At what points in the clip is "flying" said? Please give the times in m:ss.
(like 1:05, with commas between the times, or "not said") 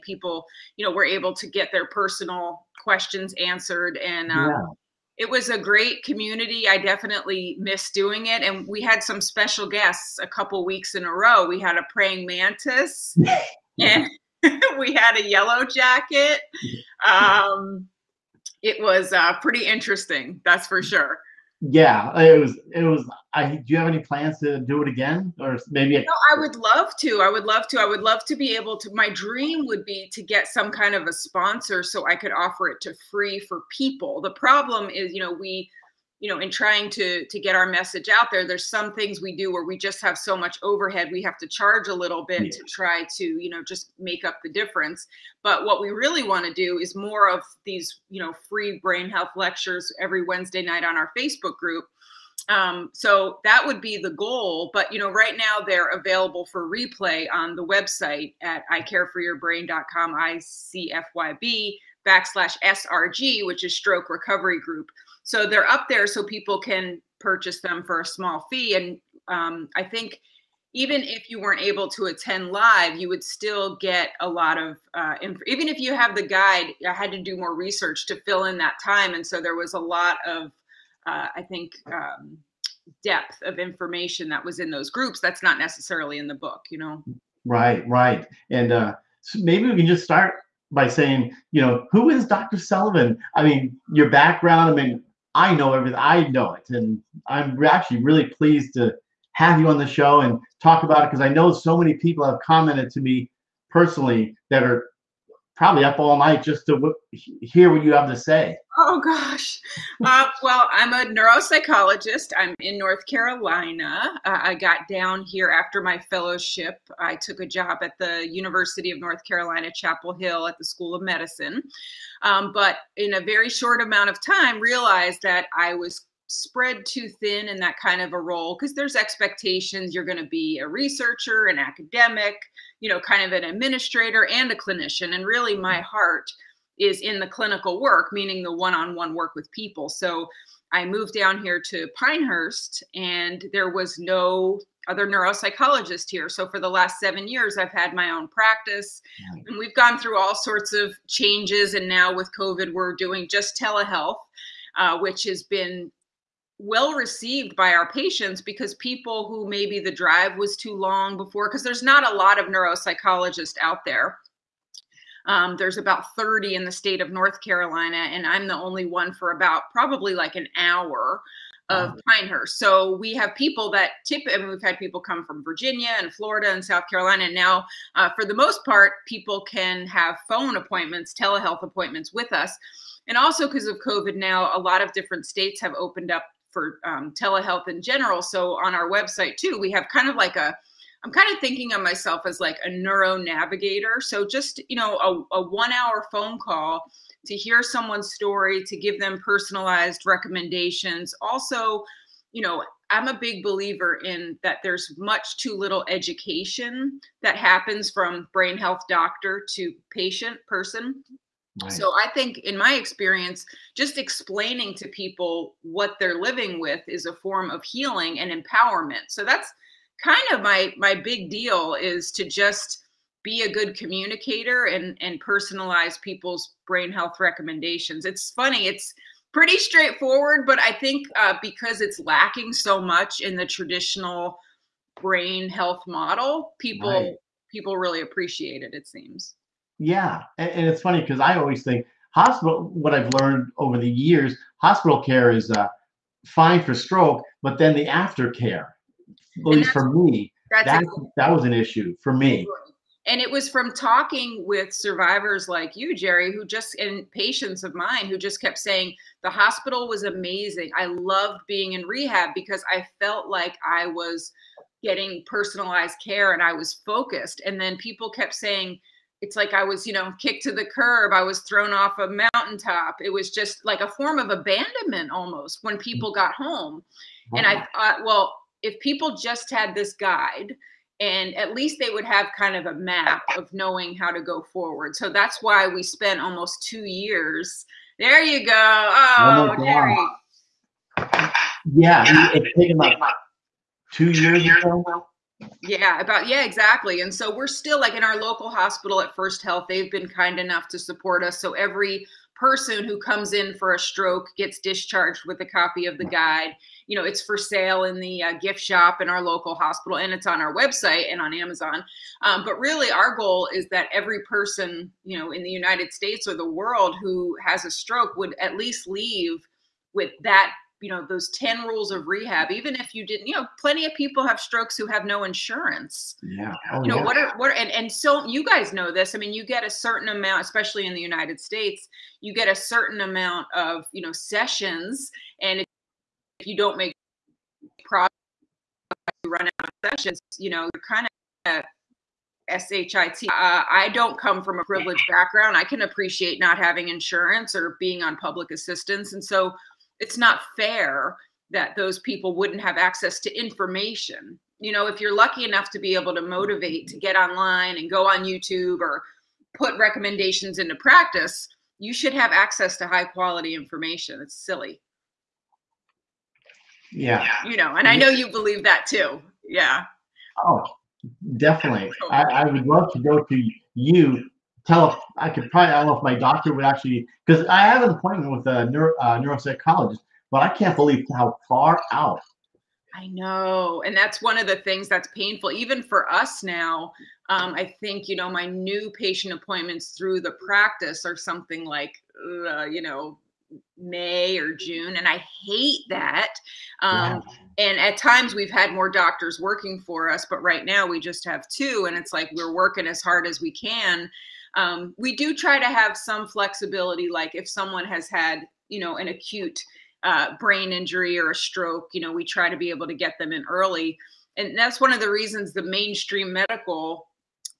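not said.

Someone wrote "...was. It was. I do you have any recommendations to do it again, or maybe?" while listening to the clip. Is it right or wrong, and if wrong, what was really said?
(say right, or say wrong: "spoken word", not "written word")
wrong: "plans", not "recommendations".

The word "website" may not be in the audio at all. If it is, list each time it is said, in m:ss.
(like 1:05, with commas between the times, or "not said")
0:57, 3:08, 5:10.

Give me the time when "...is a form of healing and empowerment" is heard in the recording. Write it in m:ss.
3:36.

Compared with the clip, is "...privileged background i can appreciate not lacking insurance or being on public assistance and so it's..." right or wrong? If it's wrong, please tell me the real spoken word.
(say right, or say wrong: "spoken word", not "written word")
wrong: "having", not "lacking".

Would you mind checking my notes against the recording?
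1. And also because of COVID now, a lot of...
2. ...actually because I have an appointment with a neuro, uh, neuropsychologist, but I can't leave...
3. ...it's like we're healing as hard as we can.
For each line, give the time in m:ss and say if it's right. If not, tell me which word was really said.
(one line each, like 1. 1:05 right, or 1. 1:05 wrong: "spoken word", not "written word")
1. 3:03 right
2. 6:16 wrong: "believe", not "leave"
3. 6:41 wrong: "working", not "healing".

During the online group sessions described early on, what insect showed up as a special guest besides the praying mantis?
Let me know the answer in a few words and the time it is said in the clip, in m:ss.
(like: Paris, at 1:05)
yellow jacket, at 0:15.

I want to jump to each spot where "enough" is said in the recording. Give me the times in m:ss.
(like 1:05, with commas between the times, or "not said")
5:00, 5:55.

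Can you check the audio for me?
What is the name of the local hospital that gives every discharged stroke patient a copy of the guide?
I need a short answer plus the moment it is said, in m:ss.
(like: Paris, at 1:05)
First Health, at 4:59.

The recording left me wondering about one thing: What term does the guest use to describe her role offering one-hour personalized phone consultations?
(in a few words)
neuro navigator.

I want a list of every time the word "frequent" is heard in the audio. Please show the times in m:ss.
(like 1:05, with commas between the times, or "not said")
not said.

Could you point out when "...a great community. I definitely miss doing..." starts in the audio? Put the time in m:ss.
0:05.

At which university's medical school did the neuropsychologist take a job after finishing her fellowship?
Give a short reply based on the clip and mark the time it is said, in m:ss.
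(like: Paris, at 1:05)
University of North Carolina, Chapel Hill, at 1:58.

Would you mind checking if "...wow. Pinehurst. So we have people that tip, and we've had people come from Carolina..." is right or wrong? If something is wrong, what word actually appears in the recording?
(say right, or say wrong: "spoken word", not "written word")
wrong: "Virginia", not "Carolina".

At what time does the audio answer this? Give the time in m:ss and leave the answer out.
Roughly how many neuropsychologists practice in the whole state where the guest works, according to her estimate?
2:46.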